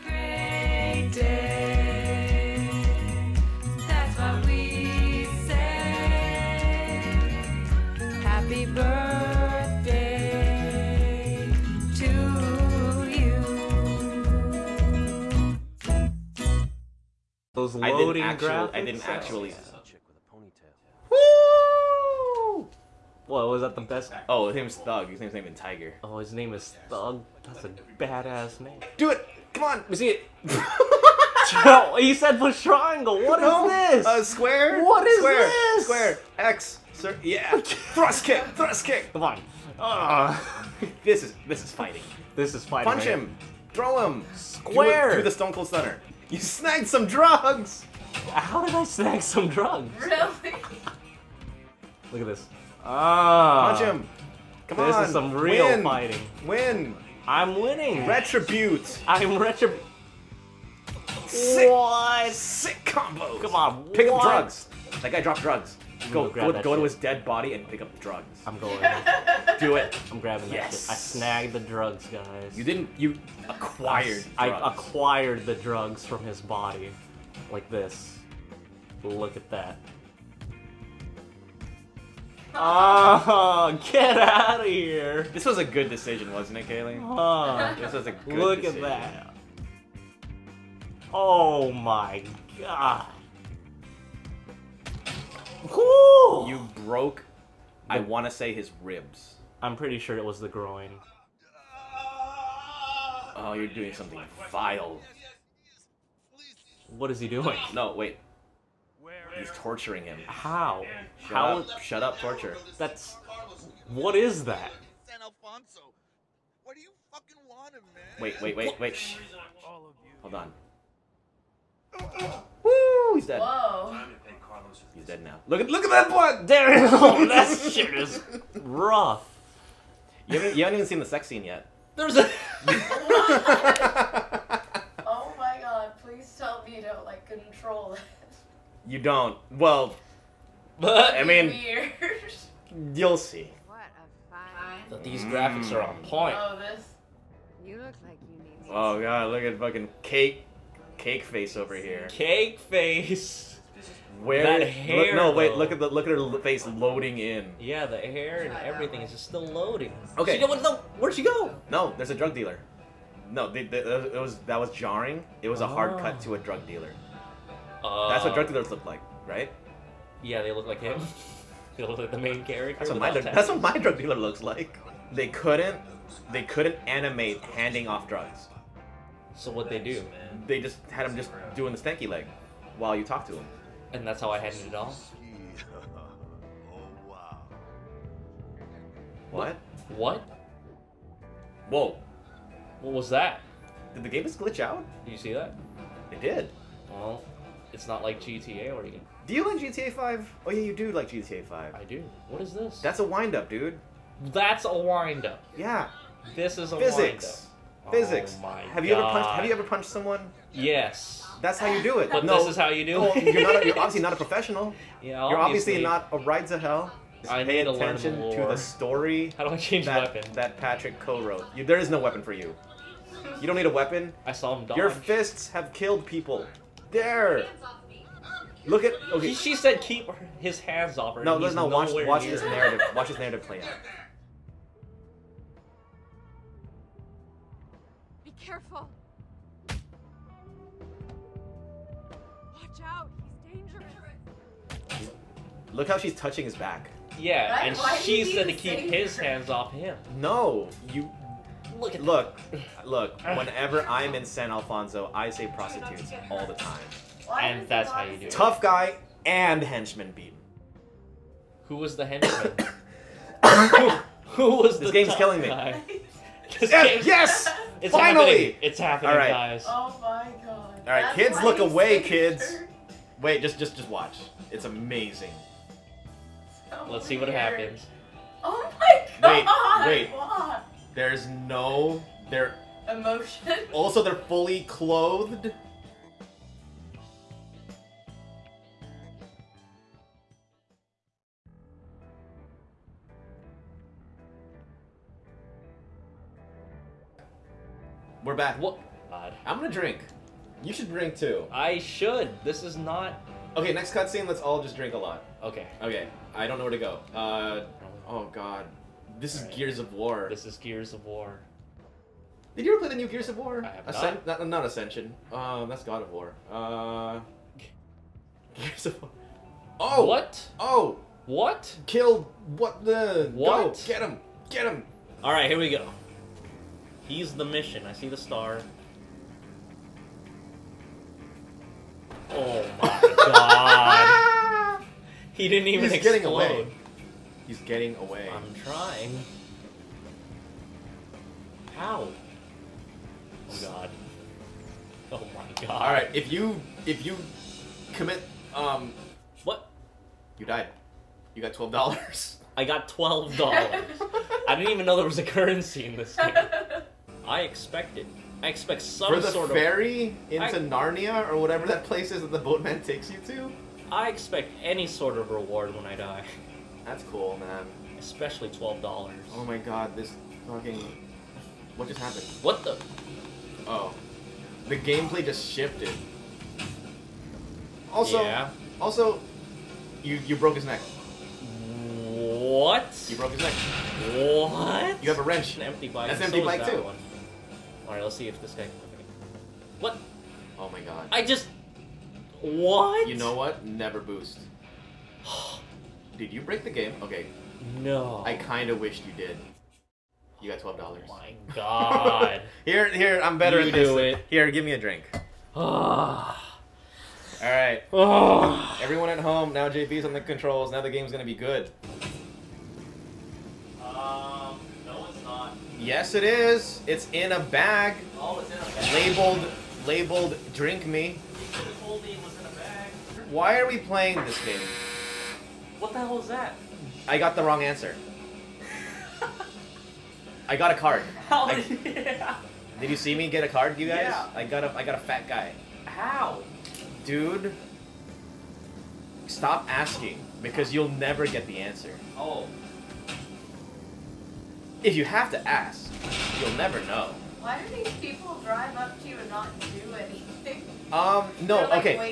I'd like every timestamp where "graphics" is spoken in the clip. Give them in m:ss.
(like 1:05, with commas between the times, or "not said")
0:18, 2:25.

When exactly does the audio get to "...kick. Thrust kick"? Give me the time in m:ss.
0:38.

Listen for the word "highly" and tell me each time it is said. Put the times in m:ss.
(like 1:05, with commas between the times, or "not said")
not said.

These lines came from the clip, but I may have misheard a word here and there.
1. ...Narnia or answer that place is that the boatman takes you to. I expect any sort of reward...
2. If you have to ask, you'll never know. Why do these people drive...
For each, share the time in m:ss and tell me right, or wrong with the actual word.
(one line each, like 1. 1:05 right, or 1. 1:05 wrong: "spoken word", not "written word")
1. 6:00 wrong: "whatever", not "answer"
2. 7:24 right.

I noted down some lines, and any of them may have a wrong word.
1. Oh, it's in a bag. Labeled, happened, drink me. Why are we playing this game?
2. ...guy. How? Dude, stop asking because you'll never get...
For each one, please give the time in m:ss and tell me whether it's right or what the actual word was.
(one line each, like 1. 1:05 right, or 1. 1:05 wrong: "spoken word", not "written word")
1. 6:58 wrong: "labeled", not "happened"
2. 7:15 right.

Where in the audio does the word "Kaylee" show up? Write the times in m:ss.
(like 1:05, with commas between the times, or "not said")
1:26.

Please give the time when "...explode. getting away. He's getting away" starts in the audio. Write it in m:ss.
5:35.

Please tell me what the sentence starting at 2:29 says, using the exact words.
Look at fucking Kate Cake face over here.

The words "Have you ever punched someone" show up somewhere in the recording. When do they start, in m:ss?
3:29.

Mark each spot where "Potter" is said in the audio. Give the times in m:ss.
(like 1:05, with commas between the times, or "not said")
not said.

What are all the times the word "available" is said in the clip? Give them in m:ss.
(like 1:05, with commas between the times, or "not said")
not said.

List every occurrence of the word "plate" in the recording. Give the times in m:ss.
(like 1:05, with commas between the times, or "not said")
not said.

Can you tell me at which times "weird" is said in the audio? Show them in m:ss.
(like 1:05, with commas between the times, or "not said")
2:21.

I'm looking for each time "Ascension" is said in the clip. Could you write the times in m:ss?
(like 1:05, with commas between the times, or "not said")
5:14.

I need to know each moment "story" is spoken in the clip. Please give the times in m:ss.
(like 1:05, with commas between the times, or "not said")
3:38.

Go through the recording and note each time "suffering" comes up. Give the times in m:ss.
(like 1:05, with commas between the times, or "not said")
not said.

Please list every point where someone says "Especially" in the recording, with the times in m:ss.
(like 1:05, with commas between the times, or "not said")
6:07.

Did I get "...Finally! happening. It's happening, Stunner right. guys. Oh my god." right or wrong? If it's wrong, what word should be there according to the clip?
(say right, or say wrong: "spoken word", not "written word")
wrong: "All", not "Stunner".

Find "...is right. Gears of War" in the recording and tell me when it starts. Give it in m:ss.
5:09.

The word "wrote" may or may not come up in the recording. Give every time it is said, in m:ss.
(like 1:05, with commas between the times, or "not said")
3:41.